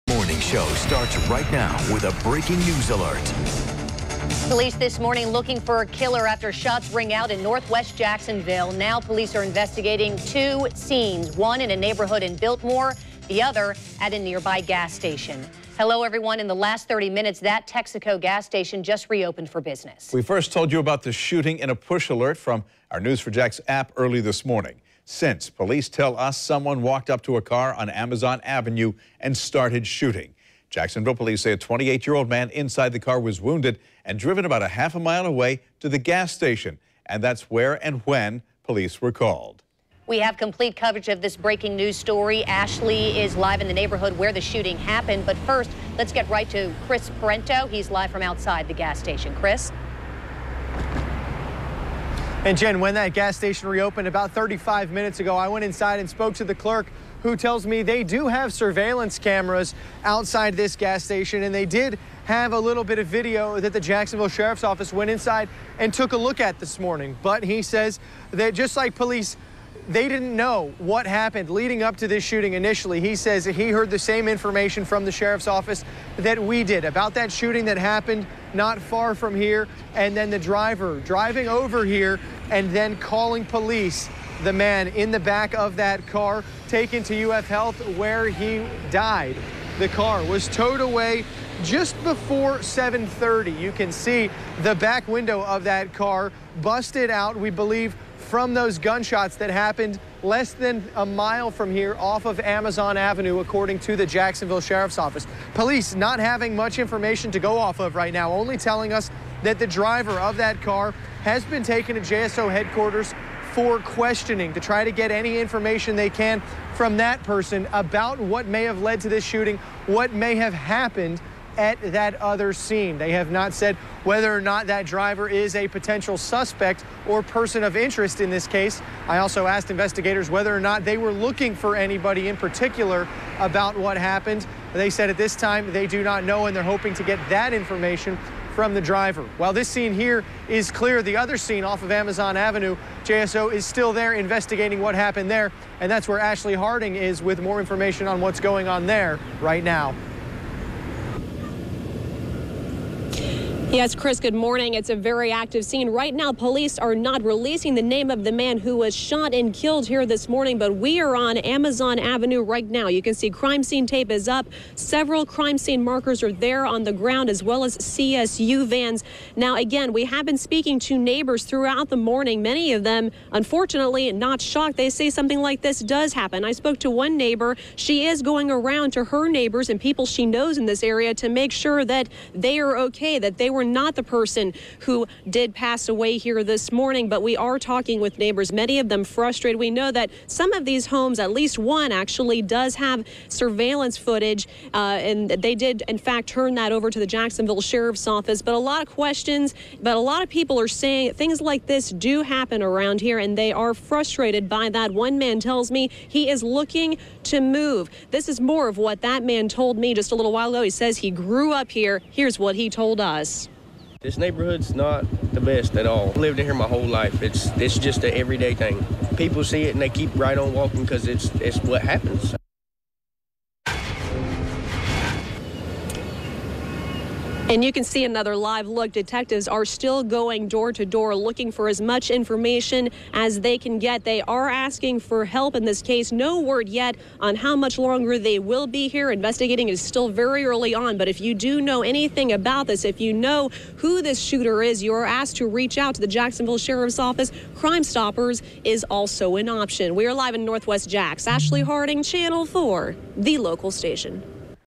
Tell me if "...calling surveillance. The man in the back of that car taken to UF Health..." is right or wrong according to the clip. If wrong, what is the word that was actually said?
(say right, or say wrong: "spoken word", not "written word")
wrong: "police", not "surveillance".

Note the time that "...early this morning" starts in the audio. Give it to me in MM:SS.
00:23.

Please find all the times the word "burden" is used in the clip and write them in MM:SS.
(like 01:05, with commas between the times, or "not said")
not said.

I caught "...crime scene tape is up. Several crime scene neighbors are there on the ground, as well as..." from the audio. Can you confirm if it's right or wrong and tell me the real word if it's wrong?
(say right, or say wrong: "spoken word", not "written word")
wrong: "markers", not "neighbors".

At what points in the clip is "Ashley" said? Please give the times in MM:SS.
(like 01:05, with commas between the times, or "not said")
00:42, 02:26, 04:11.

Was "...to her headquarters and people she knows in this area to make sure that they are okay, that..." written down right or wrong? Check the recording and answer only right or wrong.
wrong.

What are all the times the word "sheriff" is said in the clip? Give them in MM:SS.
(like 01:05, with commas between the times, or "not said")
01:04, 01:15, 01:44, 03:17, 04:06.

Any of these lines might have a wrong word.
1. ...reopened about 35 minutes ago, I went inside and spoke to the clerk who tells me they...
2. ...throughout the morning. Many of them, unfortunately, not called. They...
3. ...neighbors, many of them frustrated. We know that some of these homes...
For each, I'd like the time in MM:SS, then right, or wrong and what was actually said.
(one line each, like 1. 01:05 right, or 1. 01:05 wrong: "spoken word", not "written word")
1. 00:53 right
2. 02:51 wrong: "shocked", not "called"
3. 03:08 right.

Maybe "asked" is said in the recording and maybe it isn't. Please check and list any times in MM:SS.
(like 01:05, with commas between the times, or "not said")
02:09, 04:05.